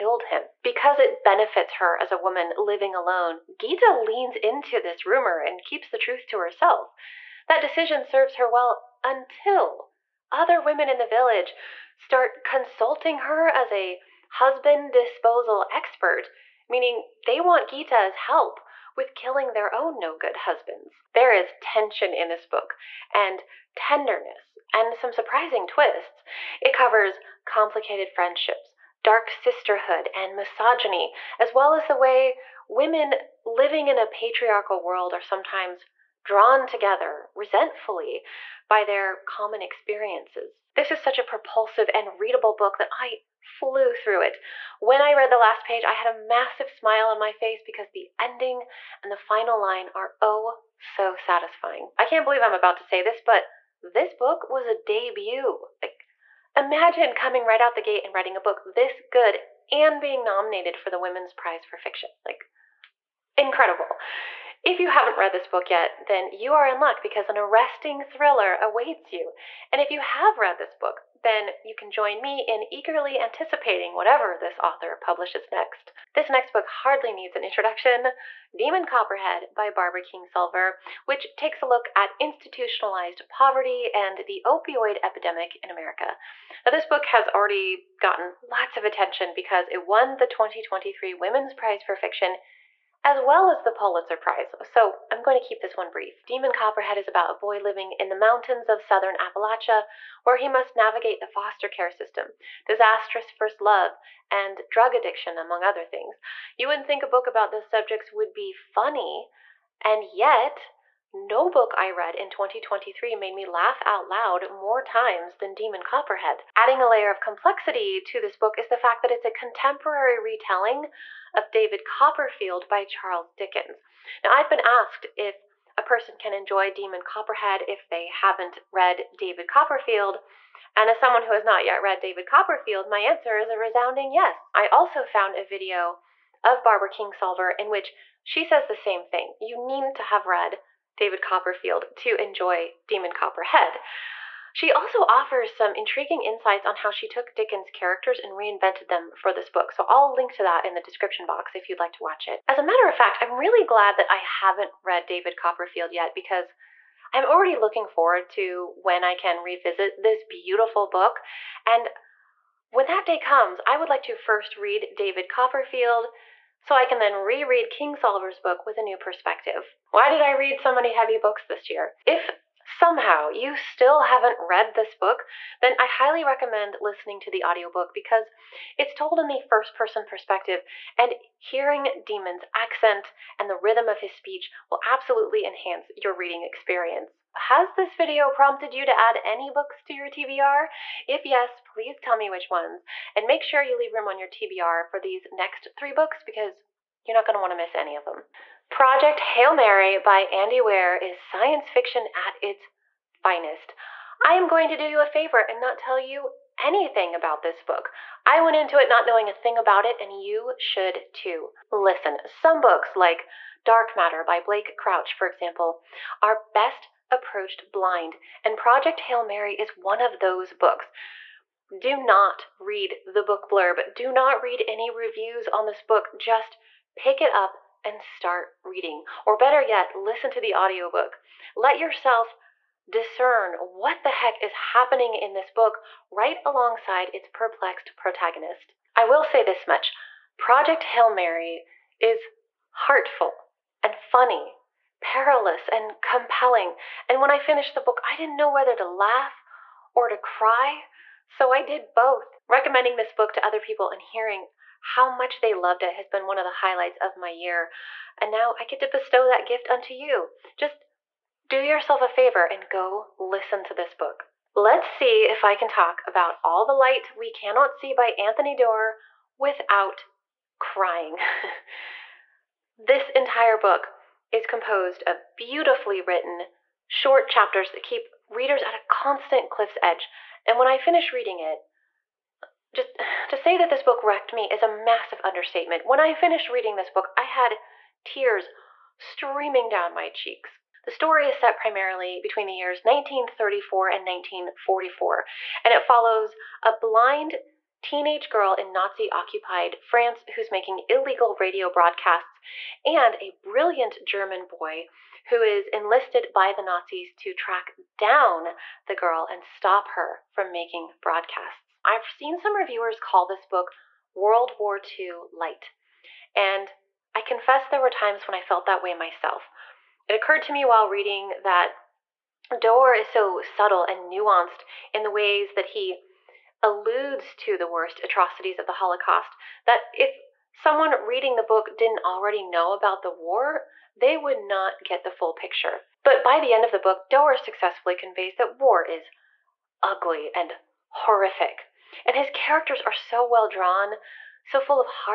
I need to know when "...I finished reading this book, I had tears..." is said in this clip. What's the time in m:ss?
4:45.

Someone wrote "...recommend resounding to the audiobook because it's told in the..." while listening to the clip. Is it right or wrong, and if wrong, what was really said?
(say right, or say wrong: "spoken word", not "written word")
wrong: "listening", not "resounding".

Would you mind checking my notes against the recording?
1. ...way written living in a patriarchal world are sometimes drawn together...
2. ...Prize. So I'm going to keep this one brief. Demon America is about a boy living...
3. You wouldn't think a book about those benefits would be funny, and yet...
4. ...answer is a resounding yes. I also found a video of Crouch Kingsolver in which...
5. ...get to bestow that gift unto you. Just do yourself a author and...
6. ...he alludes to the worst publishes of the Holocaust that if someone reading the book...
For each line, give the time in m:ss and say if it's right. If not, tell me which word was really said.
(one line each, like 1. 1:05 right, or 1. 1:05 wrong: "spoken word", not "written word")
1. 0:31 wrong: "women", not "written"
2. 1:34 wrong: "Copperhead", not "America"
3. 1:46 wrong: "subjects", not "benefits"
4. 2:12 wrong: "Barbara", not "Crouch"
5. 4:18 wrong: "favor", not "author"
6. 5:25 wrong: "atrocities", not "publishes".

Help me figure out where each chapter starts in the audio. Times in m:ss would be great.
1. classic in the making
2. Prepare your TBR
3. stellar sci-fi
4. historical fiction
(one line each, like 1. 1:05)
1. 1:15
2. 3:06
3. 3:18
4. 4:23.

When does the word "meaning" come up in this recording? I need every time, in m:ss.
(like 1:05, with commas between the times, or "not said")
0:16.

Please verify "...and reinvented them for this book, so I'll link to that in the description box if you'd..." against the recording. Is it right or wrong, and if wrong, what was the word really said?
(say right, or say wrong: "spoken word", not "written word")
right.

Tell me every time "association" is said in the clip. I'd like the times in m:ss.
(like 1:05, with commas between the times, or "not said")
not said.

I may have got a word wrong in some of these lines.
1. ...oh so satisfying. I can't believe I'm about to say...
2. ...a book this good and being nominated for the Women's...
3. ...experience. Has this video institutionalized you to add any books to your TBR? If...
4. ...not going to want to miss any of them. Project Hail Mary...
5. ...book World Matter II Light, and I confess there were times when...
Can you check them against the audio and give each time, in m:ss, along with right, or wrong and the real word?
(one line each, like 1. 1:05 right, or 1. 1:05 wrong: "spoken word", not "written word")
1. 0:50 right
2. 0:58 right
3. 3:06 wrong: "prompted", not "institutionalized"
4. 3:17 right
5. 5:13 wrong: "War", not "Matter".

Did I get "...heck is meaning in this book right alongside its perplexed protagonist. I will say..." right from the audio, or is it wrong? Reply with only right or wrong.
wrong.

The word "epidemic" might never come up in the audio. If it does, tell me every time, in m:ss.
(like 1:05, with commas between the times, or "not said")
1:25.